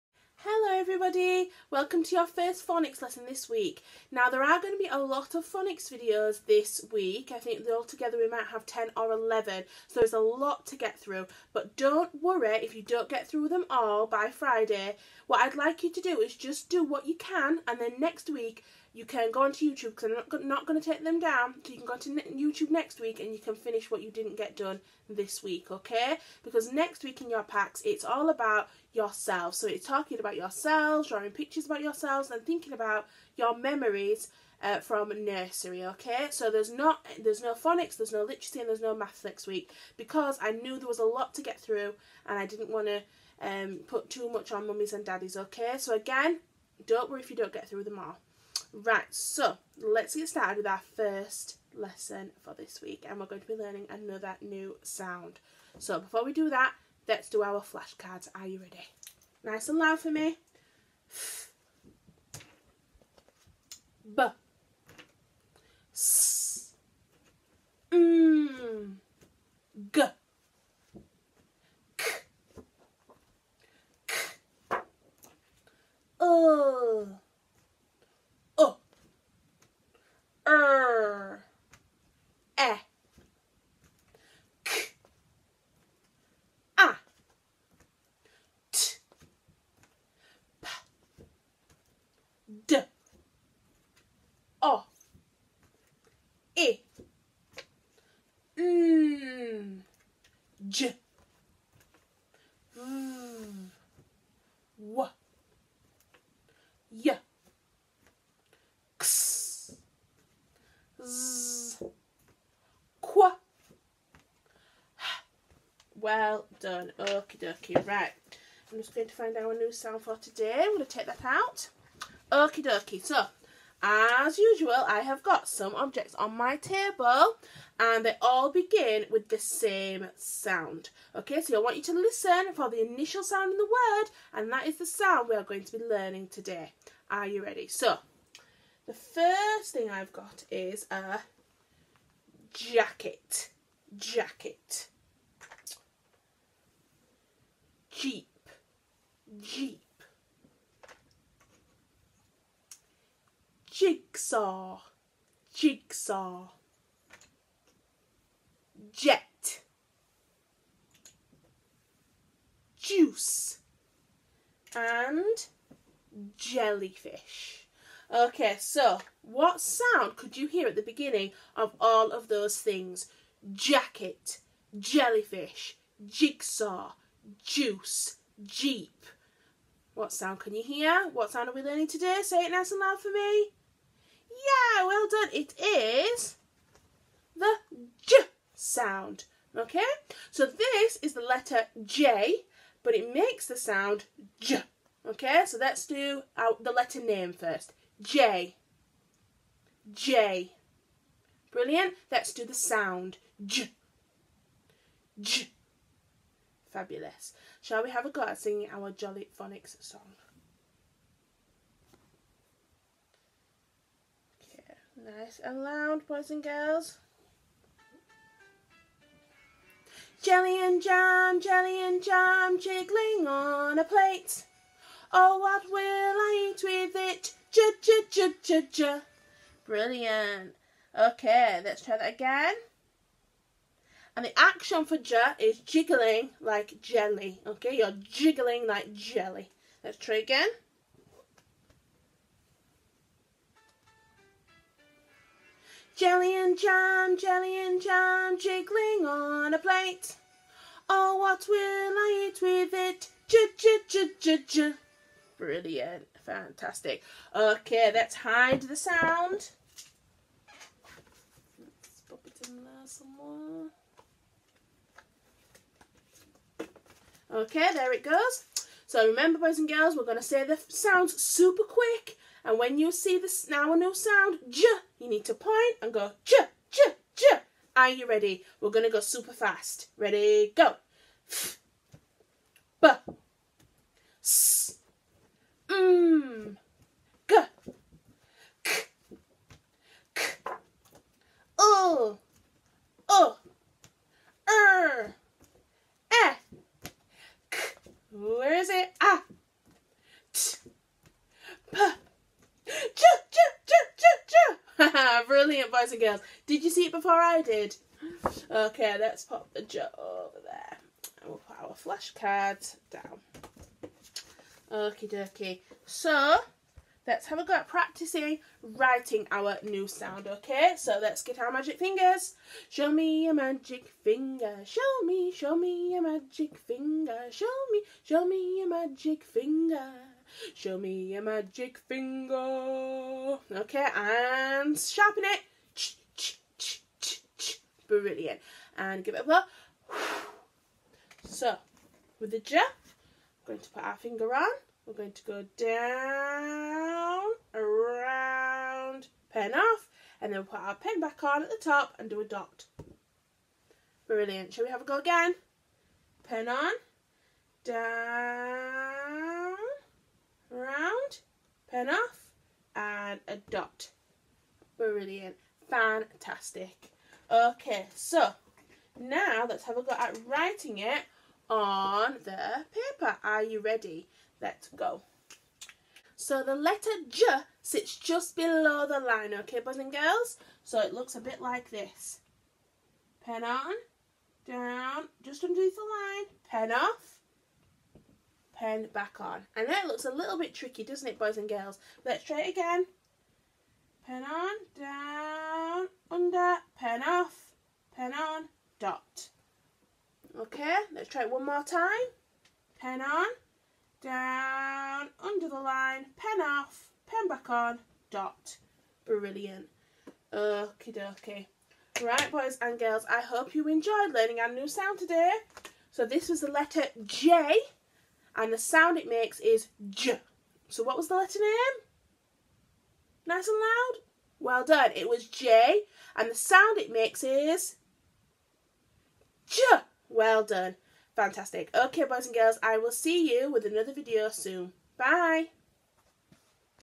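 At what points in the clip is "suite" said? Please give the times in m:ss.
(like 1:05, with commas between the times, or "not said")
not said.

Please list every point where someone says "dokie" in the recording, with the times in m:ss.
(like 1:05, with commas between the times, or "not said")
1:57, 2:02, 5:15, 6:50.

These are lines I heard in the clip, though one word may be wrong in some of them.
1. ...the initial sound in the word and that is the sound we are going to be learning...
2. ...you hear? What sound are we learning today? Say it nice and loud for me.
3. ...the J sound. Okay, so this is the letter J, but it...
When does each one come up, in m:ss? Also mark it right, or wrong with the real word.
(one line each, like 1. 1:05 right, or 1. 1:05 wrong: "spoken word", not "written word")
1. 2:12 right
2. 3:00 right
3. 3:07 right.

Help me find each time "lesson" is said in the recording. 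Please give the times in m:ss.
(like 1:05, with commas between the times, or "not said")
0:03, 0:51.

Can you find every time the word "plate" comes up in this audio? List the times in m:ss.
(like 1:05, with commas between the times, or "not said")
3:43, 4:09.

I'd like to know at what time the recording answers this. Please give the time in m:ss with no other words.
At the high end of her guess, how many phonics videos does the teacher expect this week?
0:09.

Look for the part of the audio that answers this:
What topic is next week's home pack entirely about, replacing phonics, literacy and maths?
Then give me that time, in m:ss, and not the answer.
0:27.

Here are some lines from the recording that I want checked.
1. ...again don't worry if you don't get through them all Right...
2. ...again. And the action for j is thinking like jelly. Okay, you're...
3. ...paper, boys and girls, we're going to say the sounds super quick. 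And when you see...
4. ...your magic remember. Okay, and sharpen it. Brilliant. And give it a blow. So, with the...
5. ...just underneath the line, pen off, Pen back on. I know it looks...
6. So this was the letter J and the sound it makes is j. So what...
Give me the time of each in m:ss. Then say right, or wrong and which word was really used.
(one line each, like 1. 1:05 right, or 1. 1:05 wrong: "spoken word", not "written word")
1. 0:45 right
2. 3:52 wrong: "jiggling", not "thinking"
3. 4:29 wrong: "remember", not "paper"
4. 5:31 wrong: "finger", not "remember"
5. 6:25 right
6. 6:55 right.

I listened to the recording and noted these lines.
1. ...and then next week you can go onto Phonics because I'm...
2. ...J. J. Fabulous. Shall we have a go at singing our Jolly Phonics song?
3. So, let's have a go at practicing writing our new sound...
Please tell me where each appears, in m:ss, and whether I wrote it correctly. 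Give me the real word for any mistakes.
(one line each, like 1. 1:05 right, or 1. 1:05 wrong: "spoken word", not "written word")
1. 0:17 wrong: "YouTube", not "Phonics"
2. 3:23 right
3. 5:15 right.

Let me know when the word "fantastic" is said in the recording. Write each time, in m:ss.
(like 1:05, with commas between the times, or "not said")
4:16, 6:05, 7:11.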